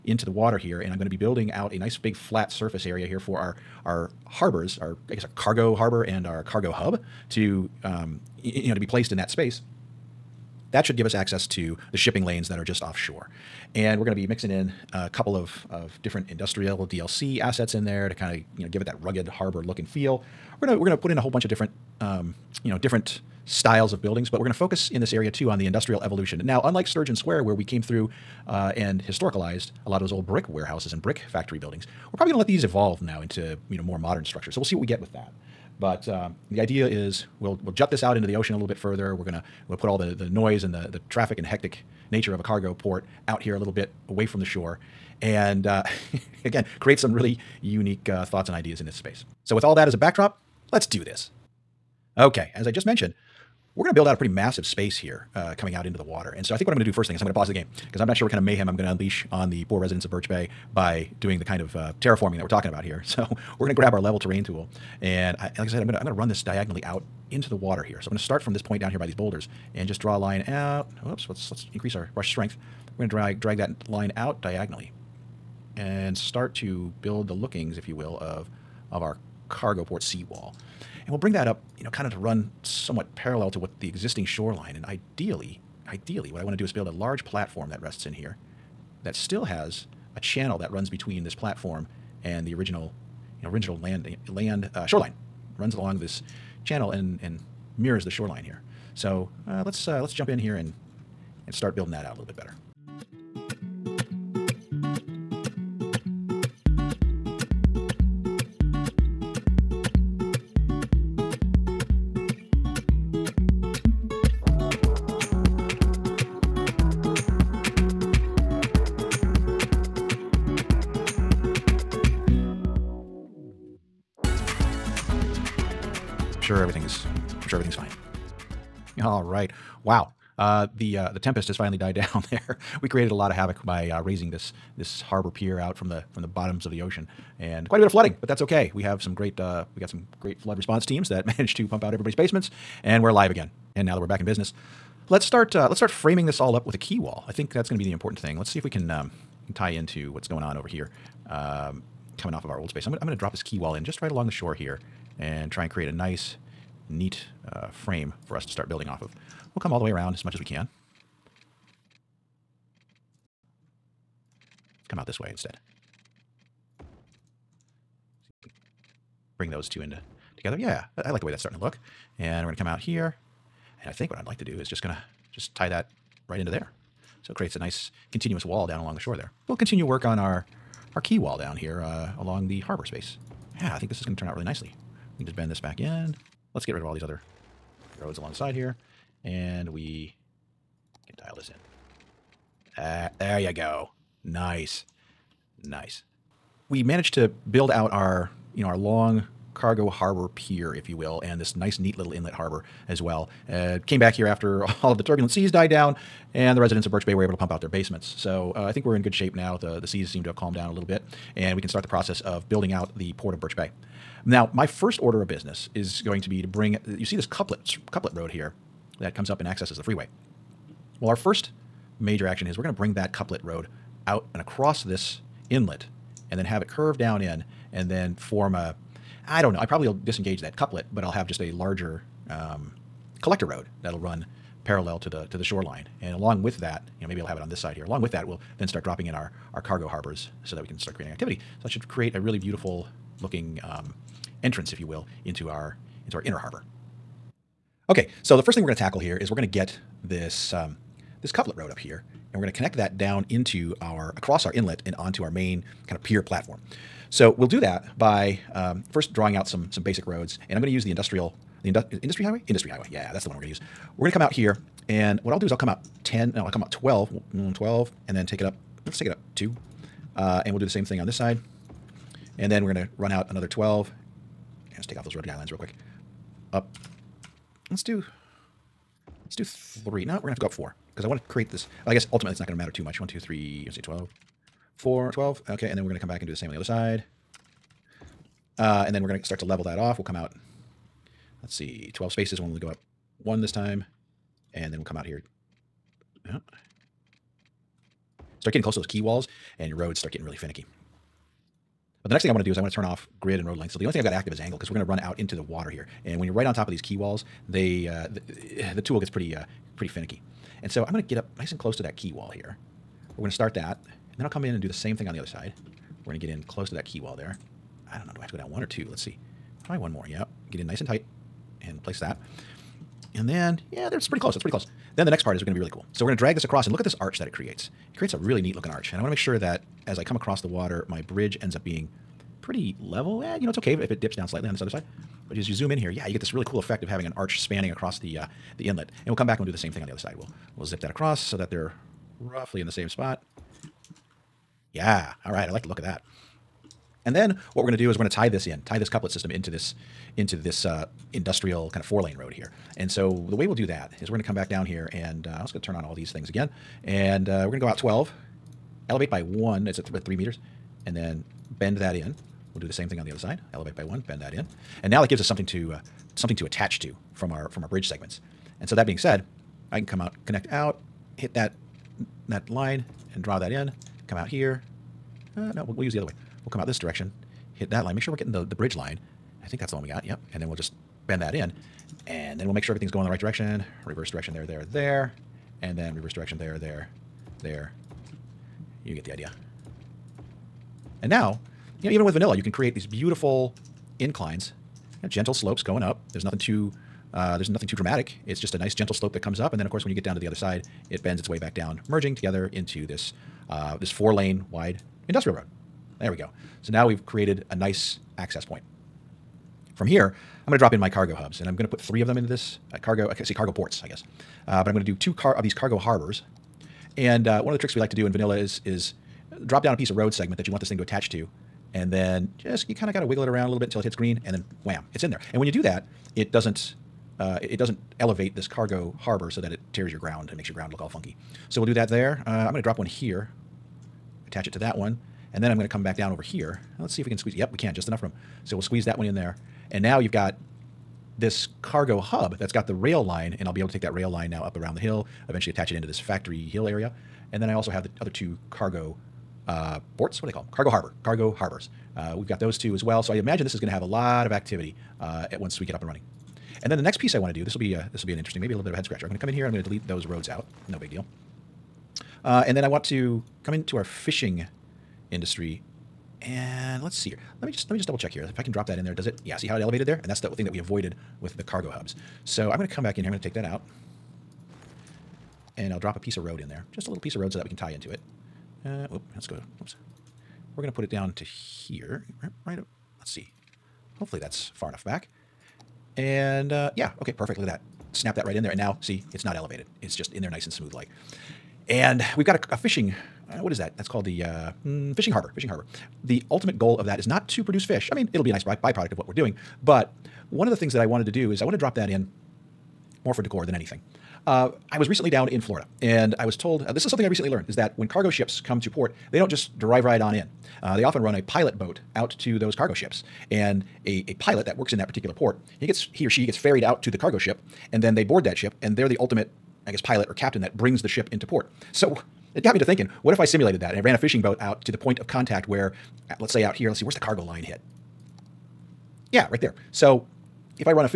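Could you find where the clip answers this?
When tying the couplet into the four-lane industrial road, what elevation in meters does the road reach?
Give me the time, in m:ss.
6:00.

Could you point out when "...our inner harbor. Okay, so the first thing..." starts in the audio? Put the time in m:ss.
4:06.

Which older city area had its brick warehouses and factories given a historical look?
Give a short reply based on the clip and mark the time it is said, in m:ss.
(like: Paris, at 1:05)
Sturgeon Square, at 0:26.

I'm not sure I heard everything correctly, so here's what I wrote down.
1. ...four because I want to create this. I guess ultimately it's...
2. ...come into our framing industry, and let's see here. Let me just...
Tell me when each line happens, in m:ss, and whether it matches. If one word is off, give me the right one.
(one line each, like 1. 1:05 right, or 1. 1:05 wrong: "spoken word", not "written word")
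1. 4:40 right
2. 7:43 wrong: "fishing", not "framing".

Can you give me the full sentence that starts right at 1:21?
And we'll bring that up, you know, kind of to run somewhat parallel to what the existing shoreline.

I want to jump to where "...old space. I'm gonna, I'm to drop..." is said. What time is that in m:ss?
2:32.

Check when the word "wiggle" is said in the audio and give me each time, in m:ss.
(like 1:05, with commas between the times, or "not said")
7:03.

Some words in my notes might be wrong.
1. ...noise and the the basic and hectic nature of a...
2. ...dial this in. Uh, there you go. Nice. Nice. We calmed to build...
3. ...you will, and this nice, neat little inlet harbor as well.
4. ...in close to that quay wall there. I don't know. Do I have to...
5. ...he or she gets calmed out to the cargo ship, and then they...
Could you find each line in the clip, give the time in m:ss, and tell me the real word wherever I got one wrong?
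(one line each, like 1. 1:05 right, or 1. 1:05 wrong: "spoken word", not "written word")
1. 0:40 wrong: "traffic", not "basic"
2. 3:11 wrong: "managed", not "calmed"
3. 3:20 right
4. 5:16 right
5. 8:35 wrong: "ferried", not "calmed".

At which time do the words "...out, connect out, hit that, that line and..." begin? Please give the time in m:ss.
6:10.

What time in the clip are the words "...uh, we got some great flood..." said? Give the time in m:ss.
2:19.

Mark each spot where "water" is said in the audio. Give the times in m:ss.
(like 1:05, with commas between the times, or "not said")
0:00, 0:56, 1:07, 5:05, 5:30.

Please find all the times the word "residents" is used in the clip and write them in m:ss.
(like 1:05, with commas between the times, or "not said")
0:59, 3:26.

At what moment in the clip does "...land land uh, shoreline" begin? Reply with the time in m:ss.
1:33.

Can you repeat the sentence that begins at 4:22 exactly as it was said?
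Yeah, that's the one we're going to use.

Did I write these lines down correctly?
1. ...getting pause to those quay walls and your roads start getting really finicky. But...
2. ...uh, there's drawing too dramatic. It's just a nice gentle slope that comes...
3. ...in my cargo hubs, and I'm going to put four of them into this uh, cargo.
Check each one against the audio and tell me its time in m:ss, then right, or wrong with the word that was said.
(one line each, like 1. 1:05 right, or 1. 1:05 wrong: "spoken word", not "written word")
1. 4:58 wrong: "close", not "pause"
2. 6:37 wrong: "nothing", not "drawing"
3. 6:50 wrong: "three", not "four".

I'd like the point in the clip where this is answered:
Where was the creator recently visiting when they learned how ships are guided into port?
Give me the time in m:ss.
8:25.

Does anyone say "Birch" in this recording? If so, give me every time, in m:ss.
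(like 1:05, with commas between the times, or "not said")
1:00, 3:26, 3:33.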